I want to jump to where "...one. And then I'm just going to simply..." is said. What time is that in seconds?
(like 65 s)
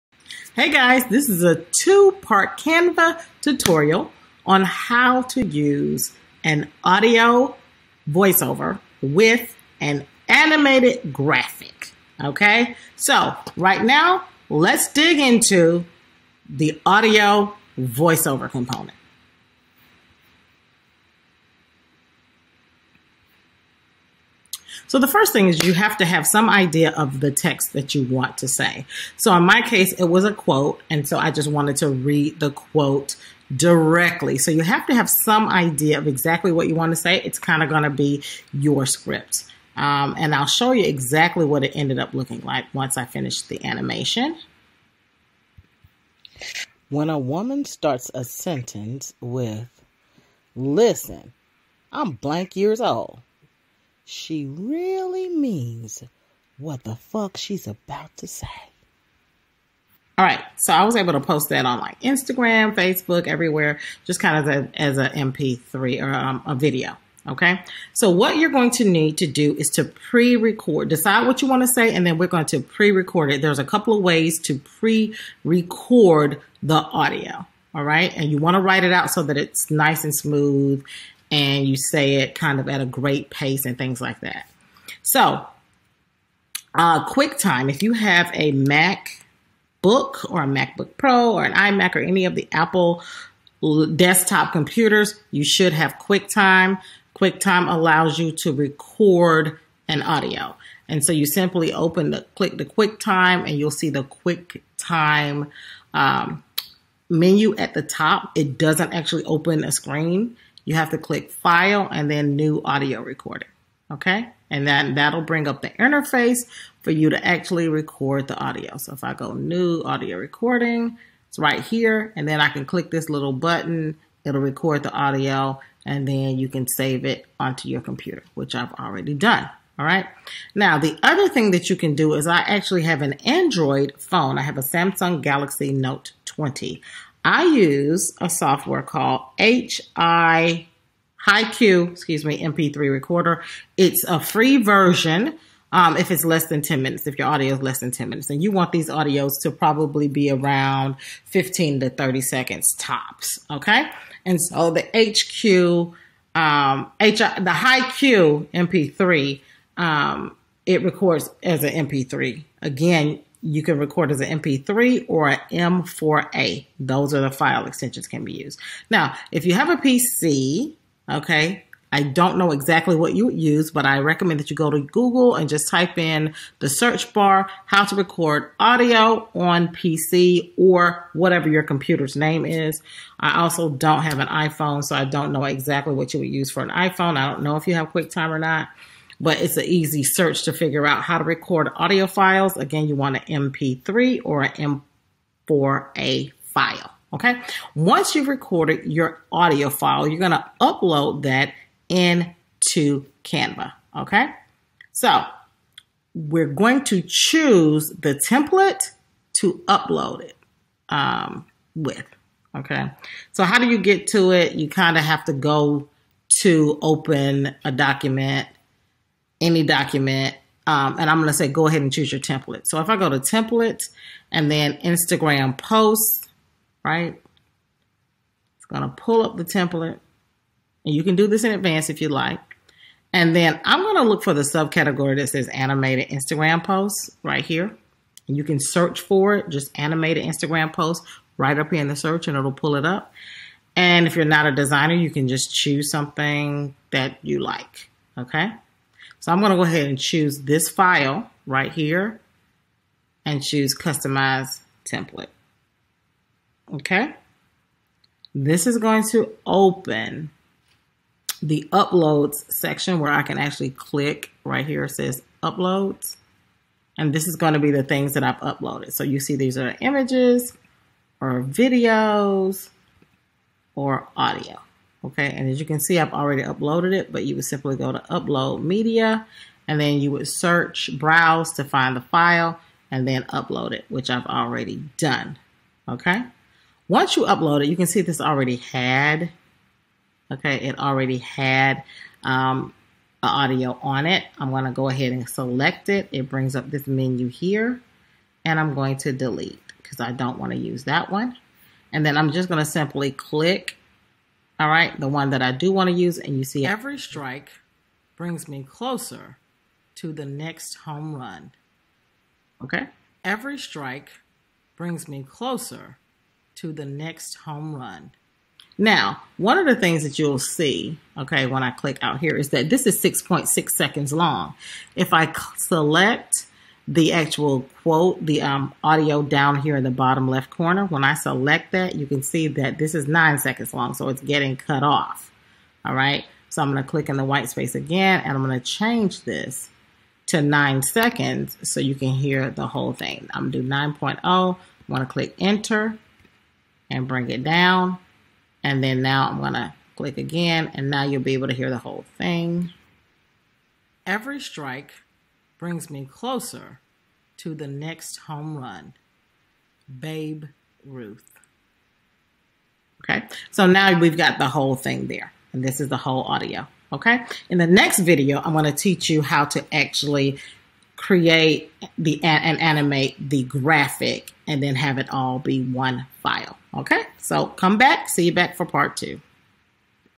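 301 s.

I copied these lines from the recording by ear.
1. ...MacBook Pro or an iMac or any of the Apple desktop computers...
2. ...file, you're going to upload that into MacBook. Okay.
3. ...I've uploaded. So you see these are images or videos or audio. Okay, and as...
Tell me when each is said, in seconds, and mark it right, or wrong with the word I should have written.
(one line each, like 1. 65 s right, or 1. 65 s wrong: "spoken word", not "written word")
1. 90 s right
2. 199 s wrong: "Canva", not "MacBook"
3. 268 s right.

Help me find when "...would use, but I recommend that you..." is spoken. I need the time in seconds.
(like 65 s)
173 s.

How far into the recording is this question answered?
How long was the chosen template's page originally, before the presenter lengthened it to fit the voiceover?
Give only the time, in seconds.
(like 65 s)
323 s.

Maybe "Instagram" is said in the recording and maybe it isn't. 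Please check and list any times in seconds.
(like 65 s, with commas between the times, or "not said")
62 s, 224 s, 236 s, 240 s.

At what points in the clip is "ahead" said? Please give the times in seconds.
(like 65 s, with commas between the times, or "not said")
221 s, 249 s, 294 s.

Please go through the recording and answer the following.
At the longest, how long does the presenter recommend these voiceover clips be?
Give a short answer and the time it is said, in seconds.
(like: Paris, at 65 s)
30 seconds, at 151 s.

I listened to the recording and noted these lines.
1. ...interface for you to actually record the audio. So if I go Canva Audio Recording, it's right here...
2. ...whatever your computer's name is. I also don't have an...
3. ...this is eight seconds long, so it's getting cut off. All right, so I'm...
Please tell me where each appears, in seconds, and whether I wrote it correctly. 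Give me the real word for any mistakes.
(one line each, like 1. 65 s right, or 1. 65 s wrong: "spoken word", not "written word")
1. 115 s wrong: "New", not "Canva"
2. 181 s right
3. 332 s wrong: "nine", not "eight".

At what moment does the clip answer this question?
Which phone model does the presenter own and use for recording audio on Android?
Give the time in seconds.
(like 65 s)
134 s.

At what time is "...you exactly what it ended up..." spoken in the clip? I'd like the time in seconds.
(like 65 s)
40 s.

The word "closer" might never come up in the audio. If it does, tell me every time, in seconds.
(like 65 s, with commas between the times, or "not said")
308 s, 315 s, 356 s.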